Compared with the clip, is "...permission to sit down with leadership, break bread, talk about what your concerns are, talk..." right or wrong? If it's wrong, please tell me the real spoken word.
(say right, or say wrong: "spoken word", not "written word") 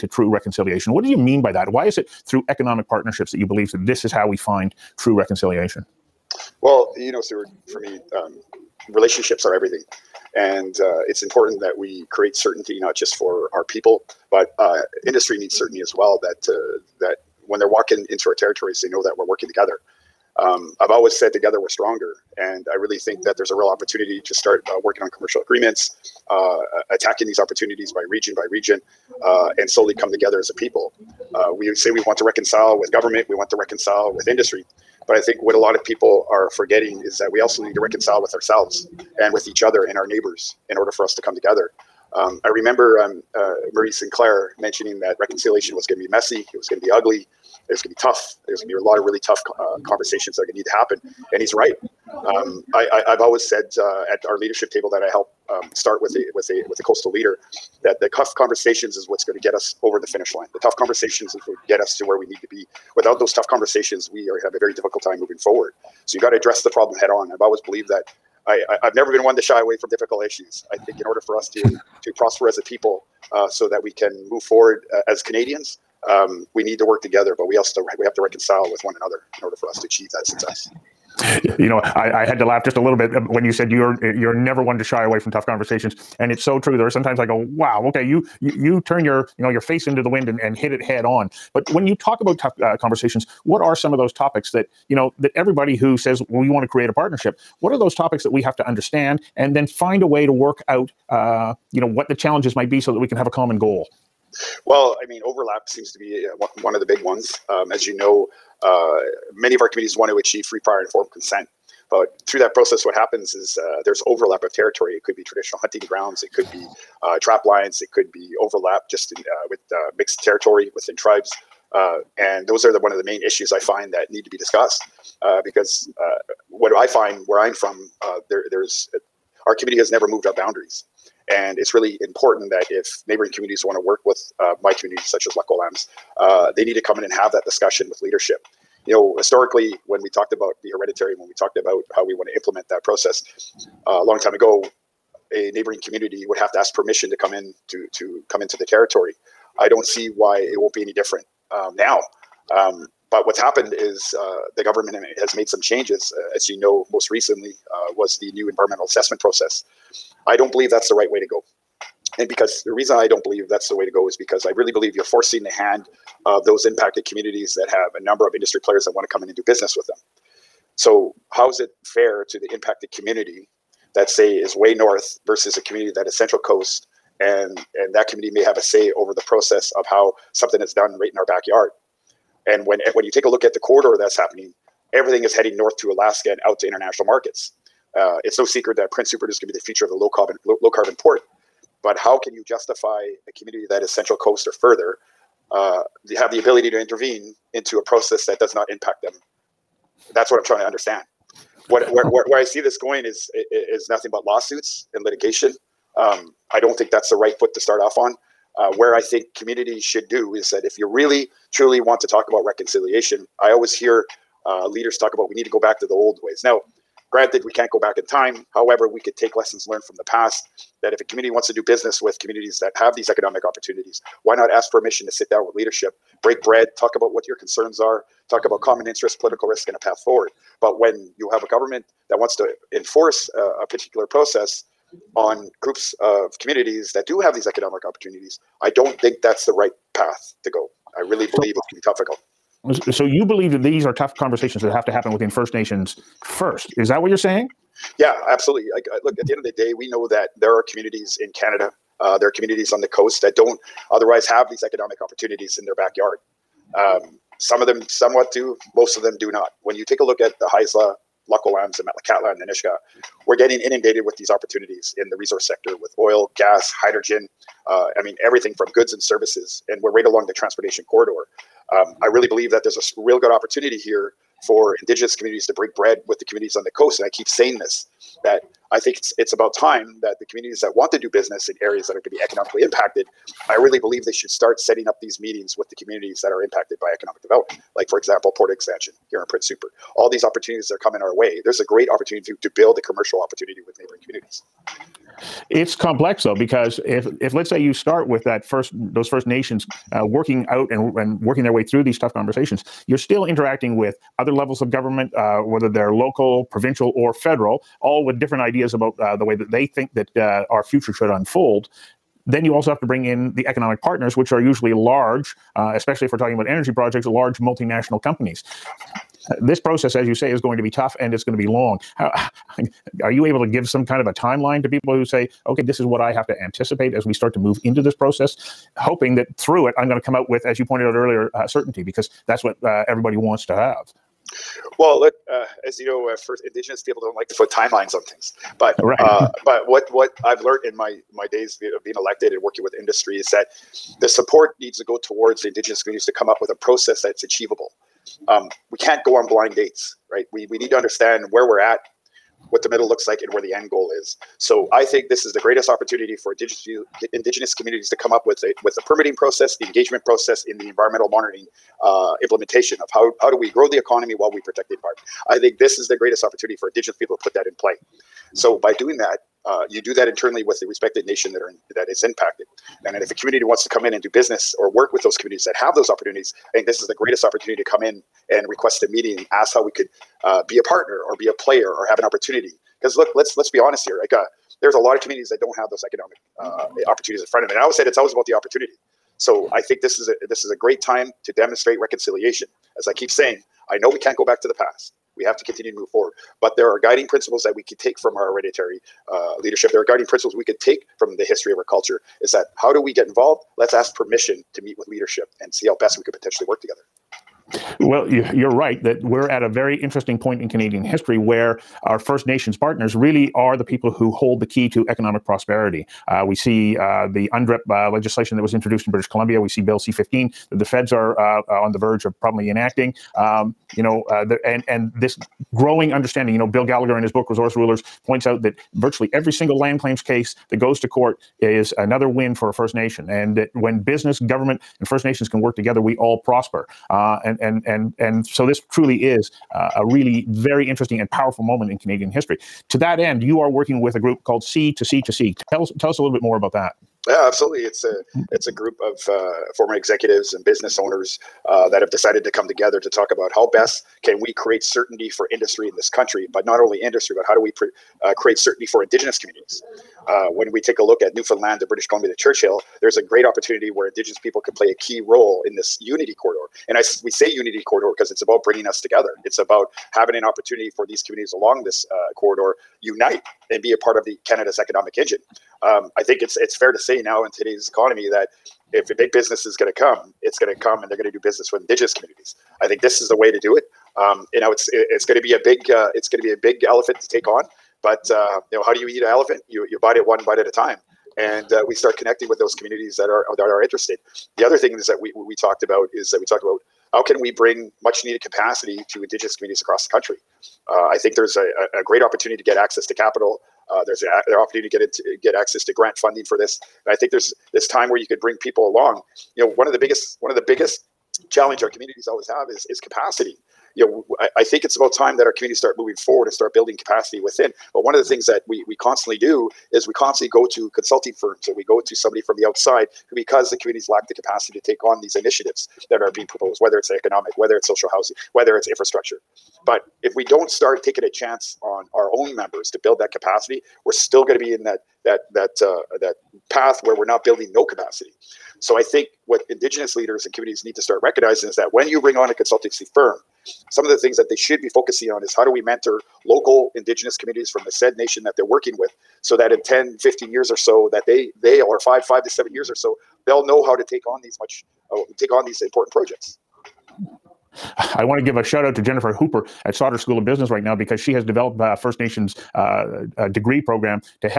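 right.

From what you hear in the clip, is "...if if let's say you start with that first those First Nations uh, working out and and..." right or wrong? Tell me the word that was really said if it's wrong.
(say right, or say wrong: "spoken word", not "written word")
right.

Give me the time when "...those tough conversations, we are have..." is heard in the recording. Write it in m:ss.
1:03.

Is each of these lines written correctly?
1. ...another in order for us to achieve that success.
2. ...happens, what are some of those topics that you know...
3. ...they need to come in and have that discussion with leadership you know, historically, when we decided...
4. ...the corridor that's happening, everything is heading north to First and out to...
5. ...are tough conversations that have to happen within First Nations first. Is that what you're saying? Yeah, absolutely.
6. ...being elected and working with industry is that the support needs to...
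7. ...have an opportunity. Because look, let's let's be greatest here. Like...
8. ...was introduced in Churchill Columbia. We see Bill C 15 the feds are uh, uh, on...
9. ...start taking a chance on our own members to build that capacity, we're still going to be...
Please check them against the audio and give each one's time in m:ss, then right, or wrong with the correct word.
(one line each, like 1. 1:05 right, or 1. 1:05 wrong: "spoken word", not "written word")
1. 1:18 right
2. 1:32 wrong: "conversations", not "happens"
3. 2:16 wrong: "talked", not "decided"
4. 3:03 wrong: "Alaska", not "First"
5. 4:03 right
6. 5:41 right
7. 6:21 wrong: "honest", not "greatest"
8. 6:58 wrong: "British", not "Churchill"
9. 8:50 right.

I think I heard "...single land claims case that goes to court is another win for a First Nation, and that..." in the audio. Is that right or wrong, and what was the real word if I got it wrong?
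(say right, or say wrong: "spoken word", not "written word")
right.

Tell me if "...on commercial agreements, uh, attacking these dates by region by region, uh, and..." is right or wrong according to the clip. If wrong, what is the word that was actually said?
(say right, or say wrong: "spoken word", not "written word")
wrong: "opportunities", not "dates".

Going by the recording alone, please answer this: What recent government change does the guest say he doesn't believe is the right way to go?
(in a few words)
new environmental assessment process.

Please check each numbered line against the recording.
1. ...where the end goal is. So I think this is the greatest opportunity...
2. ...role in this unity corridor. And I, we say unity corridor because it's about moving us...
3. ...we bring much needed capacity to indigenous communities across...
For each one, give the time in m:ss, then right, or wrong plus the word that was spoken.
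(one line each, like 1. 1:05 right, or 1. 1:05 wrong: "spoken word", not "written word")
1. 5:53 right
2. 7:44 wrong: "bringing", not "moving"
3. 8:17 right.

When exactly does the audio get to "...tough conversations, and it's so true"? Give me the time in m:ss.
1:25.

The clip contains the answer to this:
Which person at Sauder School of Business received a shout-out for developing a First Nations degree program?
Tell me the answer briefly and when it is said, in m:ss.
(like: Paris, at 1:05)
Jennifer Hooper, at 9:18.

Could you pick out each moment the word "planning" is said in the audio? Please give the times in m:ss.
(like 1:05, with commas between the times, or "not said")
not said.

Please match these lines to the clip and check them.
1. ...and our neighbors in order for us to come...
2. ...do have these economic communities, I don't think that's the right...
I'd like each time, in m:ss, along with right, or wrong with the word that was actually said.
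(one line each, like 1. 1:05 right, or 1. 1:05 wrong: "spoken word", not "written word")
1. 0:39 right
2. 3:57 wrong: "opportunities", not "communities".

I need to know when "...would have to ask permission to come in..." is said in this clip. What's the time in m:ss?
2:26.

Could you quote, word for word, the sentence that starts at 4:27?
Uh, I mean, everything from goods and services, and we're right along the transportation corridor.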